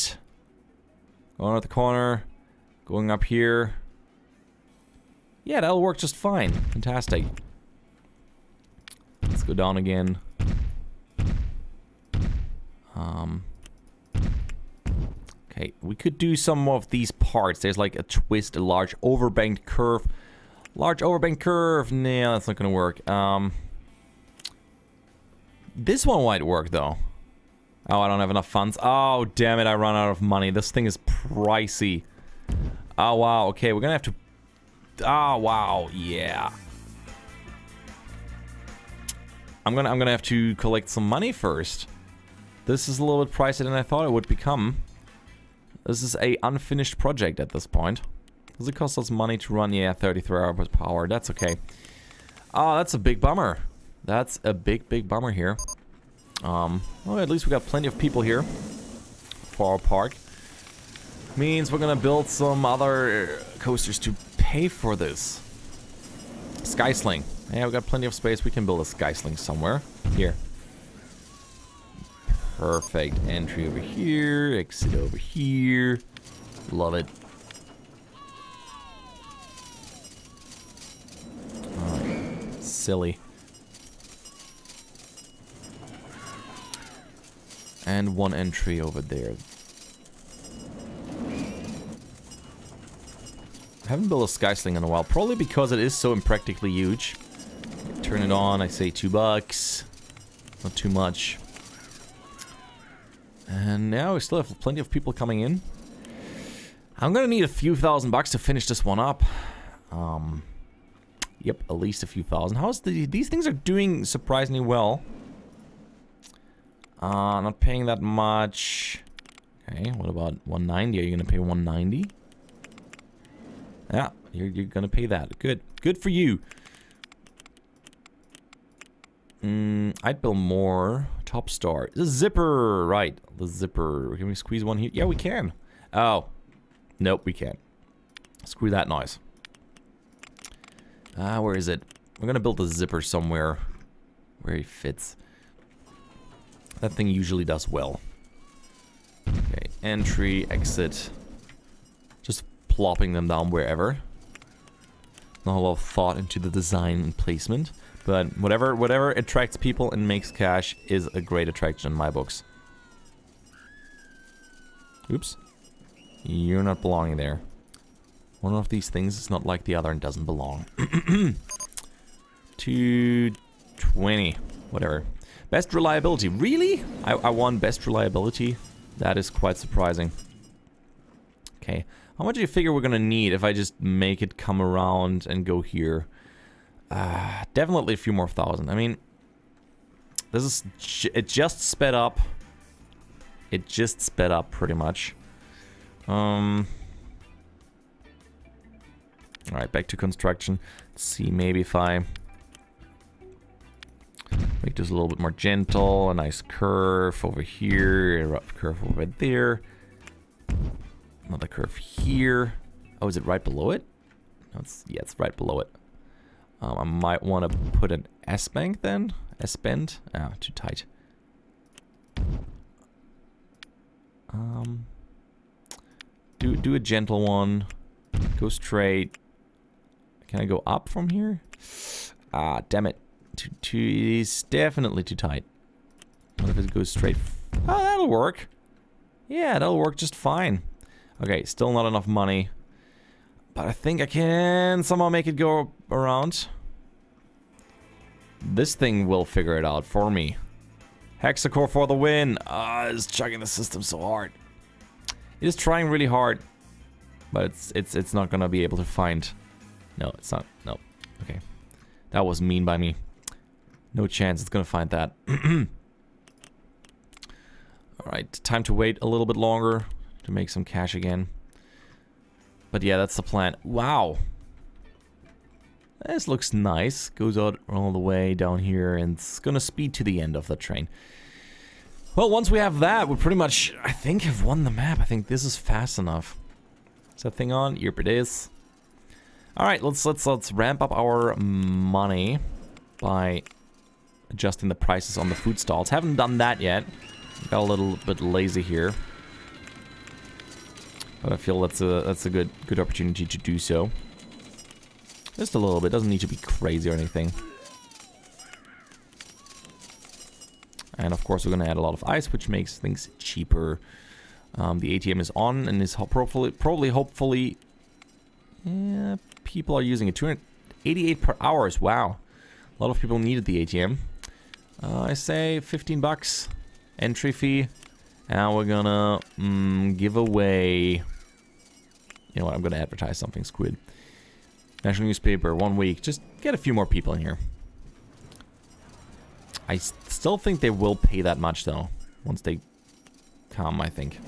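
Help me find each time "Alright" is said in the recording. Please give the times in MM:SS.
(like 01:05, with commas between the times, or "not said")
03:19, 04:28.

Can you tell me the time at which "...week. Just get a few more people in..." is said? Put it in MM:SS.
05:35.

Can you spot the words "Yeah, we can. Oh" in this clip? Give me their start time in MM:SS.
02:14.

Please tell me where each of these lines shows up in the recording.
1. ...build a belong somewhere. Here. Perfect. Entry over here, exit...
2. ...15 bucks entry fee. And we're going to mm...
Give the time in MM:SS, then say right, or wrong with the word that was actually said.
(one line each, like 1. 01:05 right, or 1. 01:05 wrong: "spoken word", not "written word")
1. 01:08 wrong: "skysling", not "belong"
2. 05:25 right.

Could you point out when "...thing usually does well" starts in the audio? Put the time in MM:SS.
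02:26.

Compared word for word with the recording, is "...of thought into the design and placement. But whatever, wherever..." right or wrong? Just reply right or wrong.
wrong.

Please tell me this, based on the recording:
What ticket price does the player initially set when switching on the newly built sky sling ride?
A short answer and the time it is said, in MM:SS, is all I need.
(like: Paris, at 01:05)
2 bucks, at 01:38.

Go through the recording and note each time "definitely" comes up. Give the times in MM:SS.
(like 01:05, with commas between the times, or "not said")
03:07, 03:54.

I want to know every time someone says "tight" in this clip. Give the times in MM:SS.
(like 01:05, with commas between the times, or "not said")
03:40, 03:55.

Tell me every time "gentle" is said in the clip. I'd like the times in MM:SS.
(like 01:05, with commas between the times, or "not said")
03:25, 03:46.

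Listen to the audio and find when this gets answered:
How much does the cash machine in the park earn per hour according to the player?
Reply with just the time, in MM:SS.
05:20.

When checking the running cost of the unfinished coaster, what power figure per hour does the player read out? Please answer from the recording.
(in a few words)
33.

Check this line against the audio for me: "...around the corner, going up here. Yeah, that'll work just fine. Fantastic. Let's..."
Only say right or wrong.
right.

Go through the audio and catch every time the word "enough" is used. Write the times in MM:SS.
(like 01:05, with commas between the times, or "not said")
00:28, 04:01, 04:45.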